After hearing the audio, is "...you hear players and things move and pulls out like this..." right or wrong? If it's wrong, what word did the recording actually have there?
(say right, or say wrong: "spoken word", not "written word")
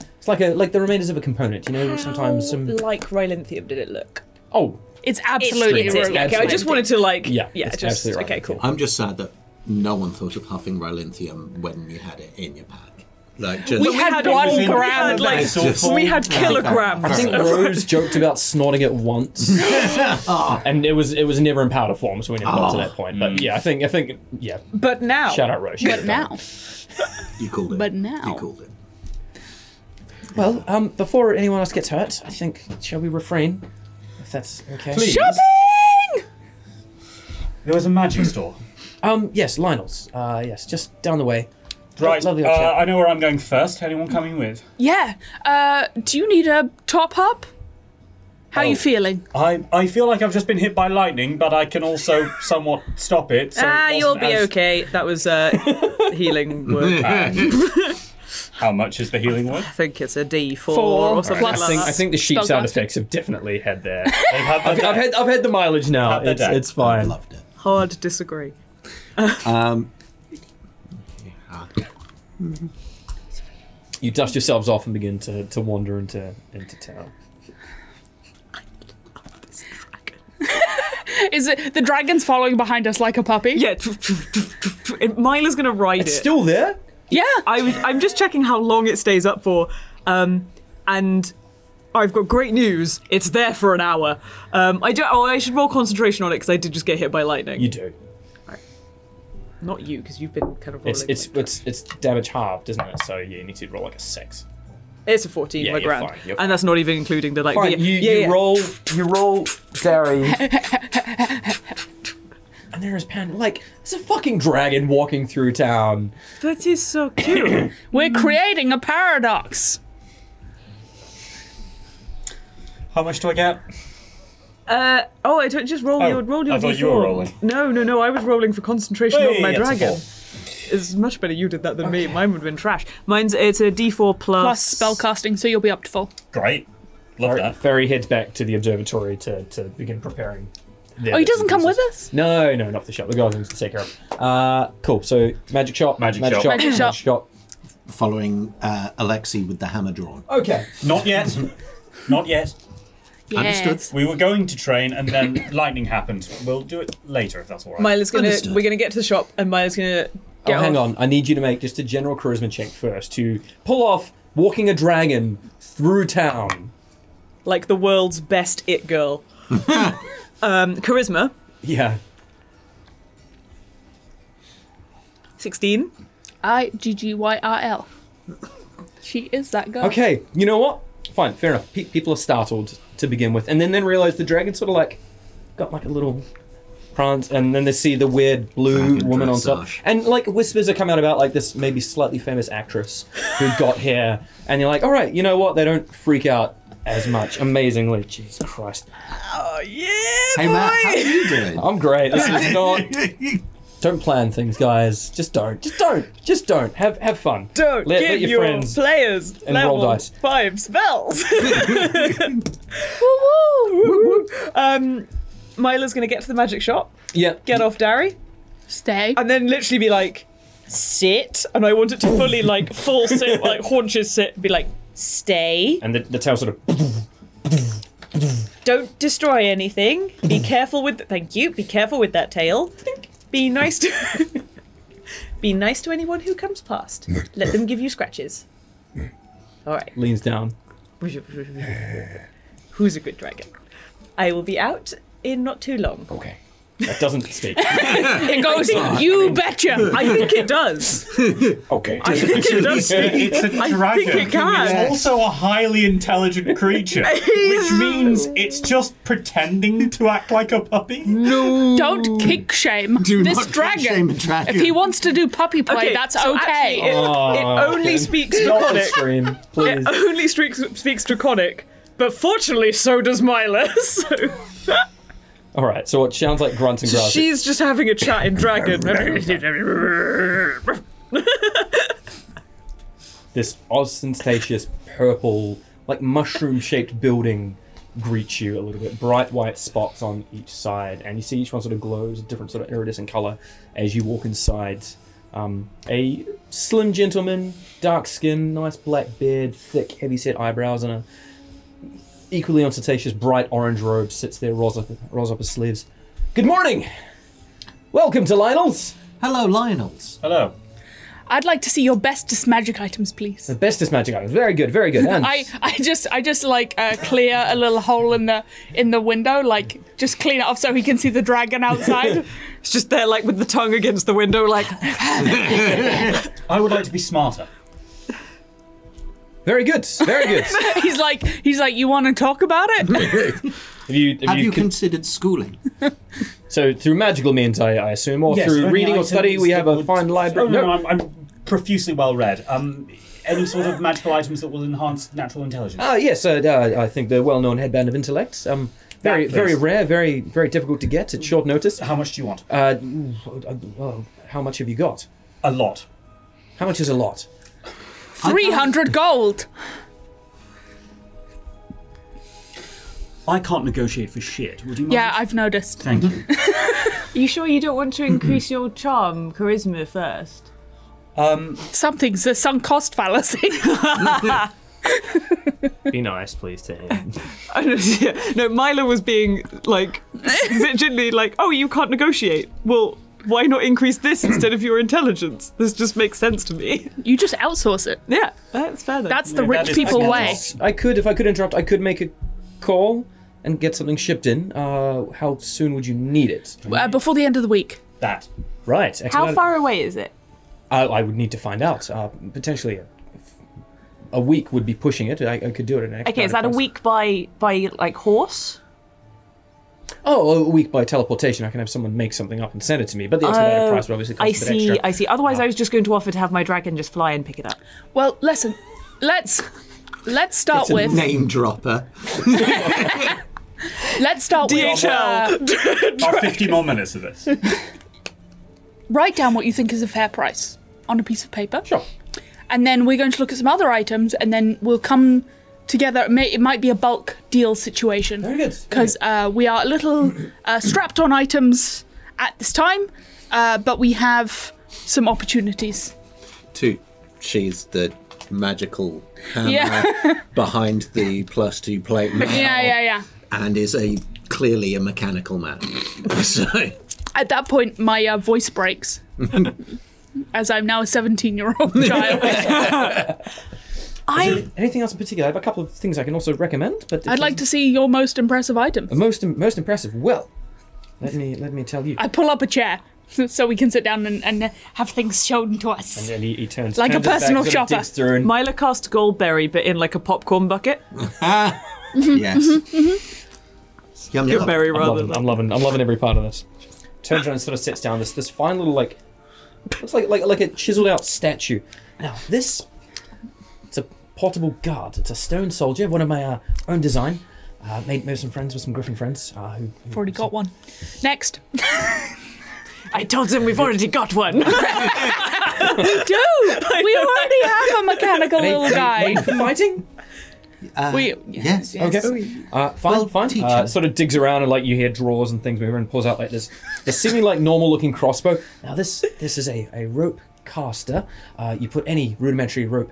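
wrong: "drawers", not "players".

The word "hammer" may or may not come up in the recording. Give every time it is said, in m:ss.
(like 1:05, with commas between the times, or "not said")
2:29, 7:29.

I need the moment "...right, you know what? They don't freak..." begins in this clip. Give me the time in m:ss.
3:14.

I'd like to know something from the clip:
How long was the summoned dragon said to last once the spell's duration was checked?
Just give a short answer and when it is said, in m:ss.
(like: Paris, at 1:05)
An hour, at 1:33.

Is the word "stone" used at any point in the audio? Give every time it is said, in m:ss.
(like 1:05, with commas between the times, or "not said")
8:15.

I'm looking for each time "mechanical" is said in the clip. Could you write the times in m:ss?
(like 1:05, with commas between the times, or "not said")
7:34, 8:27.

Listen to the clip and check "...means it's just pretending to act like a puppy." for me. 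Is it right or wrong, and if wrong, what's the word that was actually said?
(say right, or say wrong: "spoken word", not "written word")
right.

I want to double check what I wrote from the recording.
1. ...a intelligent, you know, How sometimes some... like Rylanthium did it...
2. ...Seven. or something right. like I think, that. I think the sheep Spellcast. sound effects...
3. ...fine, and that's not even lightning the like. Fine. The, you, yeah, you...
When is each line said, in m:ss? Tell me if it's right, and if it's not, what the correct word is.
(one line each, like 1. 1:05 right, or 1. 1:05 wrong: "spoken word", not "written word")
1. 0:01 wrong: "component", not "intelligent"
2. 1:00 wrong: "Four", not "Seven"
3. 1:46 wrong: "including", not "lightning".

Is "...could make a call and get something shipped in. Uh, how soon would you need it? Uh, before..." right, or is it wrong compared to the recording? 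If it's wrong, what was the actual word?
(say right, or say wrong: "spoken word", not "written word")
right.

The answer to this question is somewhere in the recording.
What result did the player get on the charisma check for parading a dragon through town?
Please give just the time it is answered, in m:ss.
2:55.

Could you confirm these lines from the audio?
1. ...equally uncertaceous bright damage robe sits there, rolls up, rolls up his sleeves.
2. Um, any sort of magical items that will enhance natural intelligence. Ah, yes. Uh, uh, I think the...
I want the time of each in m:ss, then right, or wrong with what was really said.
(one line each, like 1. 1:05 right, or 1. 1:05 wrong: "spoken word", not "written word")
1. 5:02 wrong: "orange", not "damage"
2. 5:42 right.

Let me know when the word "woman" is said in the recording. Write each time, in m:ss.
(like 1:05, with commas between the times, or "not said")
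3:09.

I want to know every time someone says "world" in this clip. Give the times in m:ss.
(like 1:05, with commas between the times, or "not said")
2:47.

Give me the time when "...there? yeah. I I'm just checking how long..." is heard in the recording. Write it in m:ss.
1:26.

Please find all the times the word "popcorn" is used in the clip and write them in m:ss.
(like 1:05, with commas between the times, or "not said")
7:59.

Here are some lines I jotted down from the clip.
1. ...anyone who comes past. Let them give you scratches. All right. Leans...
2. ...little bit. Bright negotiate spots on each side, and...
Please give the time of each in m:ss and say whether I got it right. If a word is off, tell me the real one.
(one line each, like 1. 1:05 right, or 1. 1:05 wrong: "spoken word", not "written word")
1. 3:55 right
2. 4:48 wrong: "white", not "negotiate".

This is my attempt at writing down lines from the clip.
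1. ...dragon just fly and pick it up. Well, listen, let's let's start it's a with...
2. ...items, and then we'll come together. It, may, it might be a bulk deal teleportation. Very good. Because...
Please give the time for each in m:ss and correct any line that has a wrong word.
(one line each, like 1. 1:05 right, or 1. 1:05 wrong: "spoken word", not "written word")
1. 6:56 right
2. 7:13 wrong: "situation", not "teleportation".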